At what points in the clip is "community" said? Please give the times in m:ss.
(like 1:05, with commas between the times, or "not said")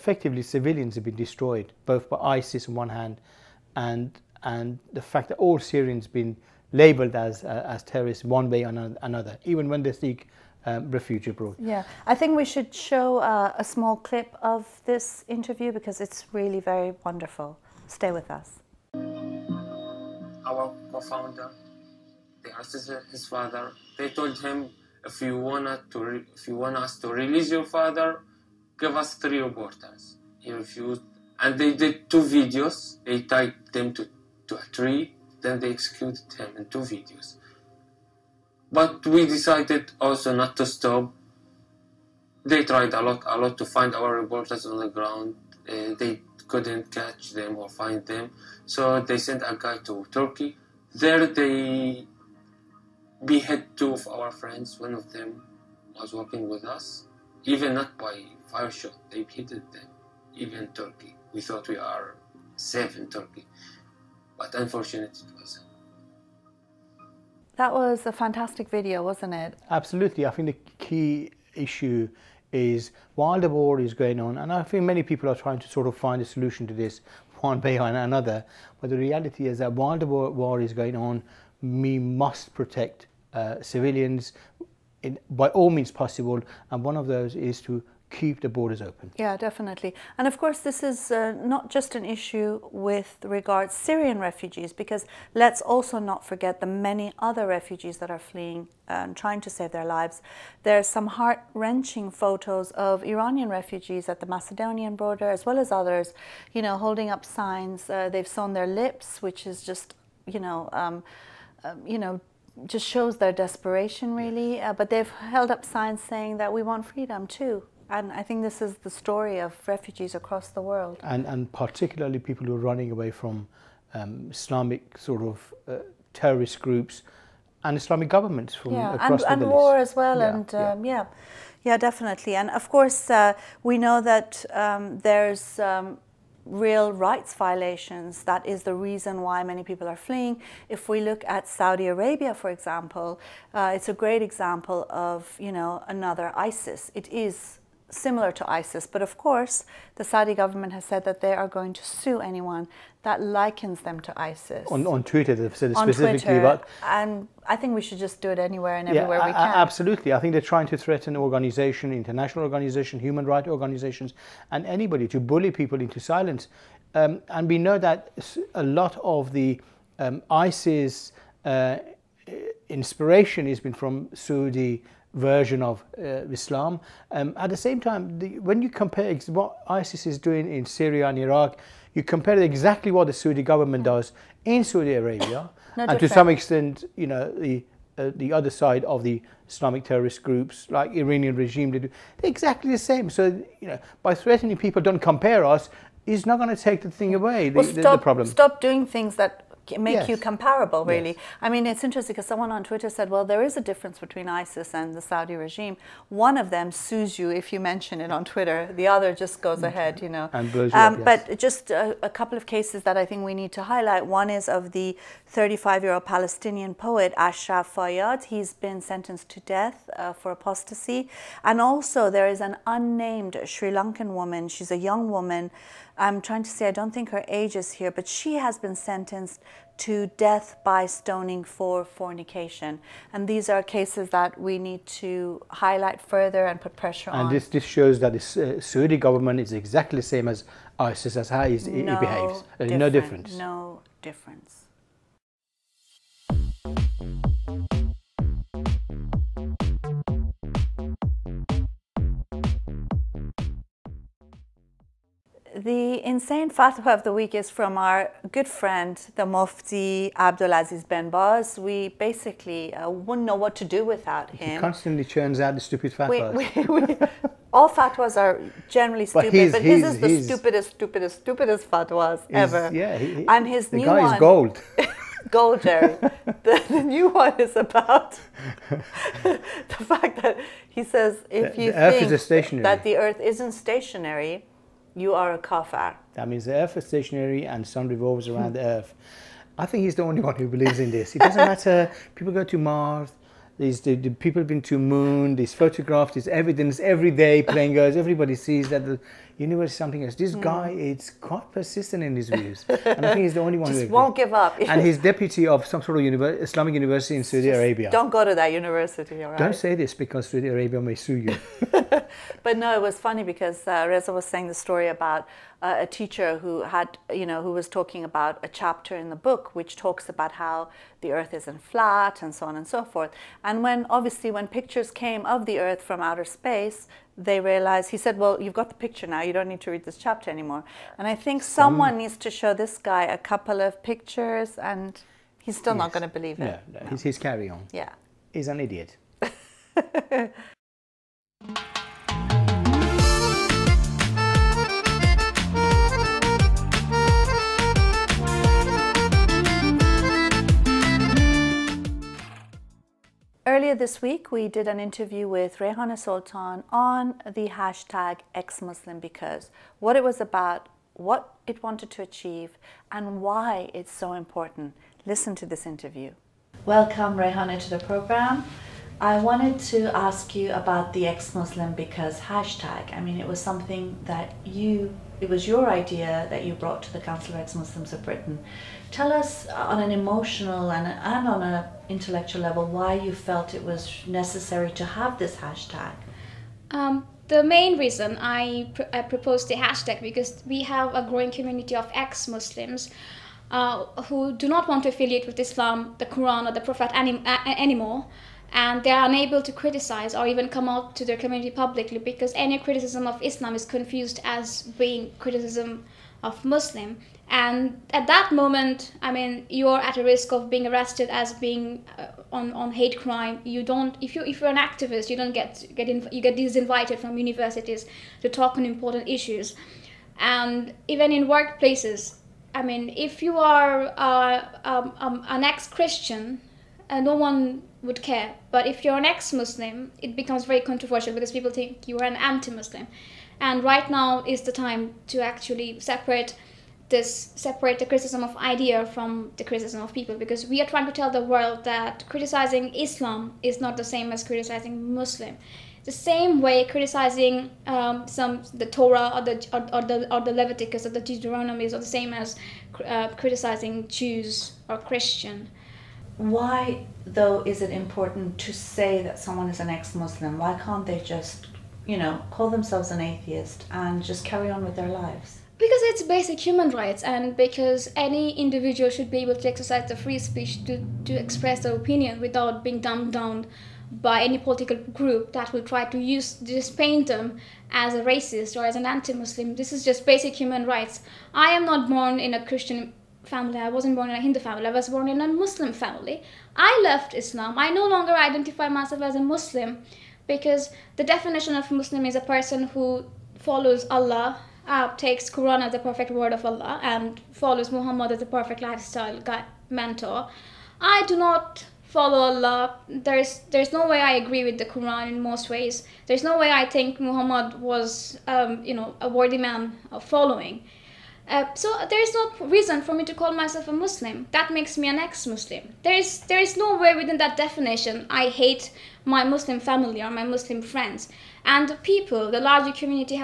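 6:31, 6:41, 8:42.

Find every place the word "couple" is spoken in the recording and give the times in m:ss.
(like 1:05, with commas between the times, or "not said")
3:32, 5:33.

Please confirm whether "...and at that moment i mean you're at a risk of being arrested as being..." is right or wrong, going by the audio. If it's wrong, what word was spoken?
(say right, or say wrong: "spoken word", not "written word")
right.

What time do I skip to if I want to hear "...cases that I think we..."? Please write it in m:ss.
3:32.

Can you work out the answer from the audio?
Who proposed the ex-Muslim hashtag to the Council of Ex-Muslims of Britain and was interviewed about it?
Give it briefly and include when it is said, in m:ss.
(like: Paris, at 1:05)
Rayhana Sultan, at 5:55.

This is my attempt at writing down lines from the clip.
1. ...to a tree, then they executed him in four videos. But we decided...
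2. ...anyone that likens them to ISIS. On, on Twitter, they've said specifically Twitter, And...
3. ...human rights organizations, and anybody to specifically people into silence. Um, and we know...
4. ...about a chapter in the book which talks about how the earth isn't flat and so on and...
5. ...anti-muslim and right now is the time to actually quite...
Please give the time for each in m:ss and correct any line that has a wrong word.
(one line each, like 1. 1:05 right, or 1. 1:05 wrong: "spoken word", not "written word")
1. 0:34 wrong: "two", not "four"
2. 2:32 right
3. 2:42 wrong: "bully", not "specifically"
4. 5:18 right
5. 7:12 wrong: "separate", not "quite".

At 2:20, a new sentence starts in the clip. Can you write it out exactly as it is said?
If we look at Saudi Arabia, for example, uh, it's a great example of you know another ISIS.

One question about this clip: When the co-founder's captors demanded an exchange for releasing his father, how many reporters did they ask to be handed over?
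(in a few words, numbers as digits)
3.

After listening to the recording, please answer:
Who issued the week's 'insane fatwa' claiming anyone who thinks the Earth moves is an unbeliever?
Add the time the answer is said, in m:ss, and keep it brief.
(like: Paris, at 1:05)
Abdulaziz Ben Baz, at 4:20.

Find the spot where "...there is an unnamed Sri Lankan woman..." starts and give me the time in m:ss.
3:42.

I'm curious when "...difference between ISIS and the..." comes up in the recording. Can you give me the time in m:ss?
3:23.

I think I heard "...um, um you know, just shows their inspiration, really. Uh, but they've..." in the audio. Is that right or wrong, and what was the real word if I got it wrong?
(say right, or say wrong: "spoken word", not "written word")
wrong: "desperation", not "inspiration".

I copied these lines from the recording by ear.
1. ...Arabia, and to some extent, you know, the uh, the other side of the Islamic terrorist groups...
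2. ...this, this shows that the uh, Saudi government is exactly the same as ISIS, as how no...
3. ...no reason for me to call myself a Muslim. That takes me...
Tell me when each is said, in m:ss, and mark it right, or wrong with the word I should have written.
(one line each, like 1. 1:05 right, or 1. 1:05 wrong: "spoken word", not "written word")
1. 3:04 right
2. 3:57 right
3. 8:32 wrong: "makes", not "takes".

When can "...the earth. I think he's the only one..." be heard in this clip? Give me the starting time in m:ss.
4:48.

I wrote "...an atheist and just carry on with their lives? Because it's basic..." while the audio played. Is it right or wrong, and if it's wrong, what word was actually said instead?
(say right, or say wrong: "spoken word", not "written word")
right.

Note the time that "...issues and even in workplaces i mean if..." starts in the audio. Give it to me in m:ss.
6:59.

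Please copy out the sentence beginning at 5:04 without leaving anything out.
and he's deputy of some sort of Islamic university in Saudi Just Arabia.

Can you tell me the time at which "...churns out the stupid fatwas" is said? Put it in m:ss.
4:25.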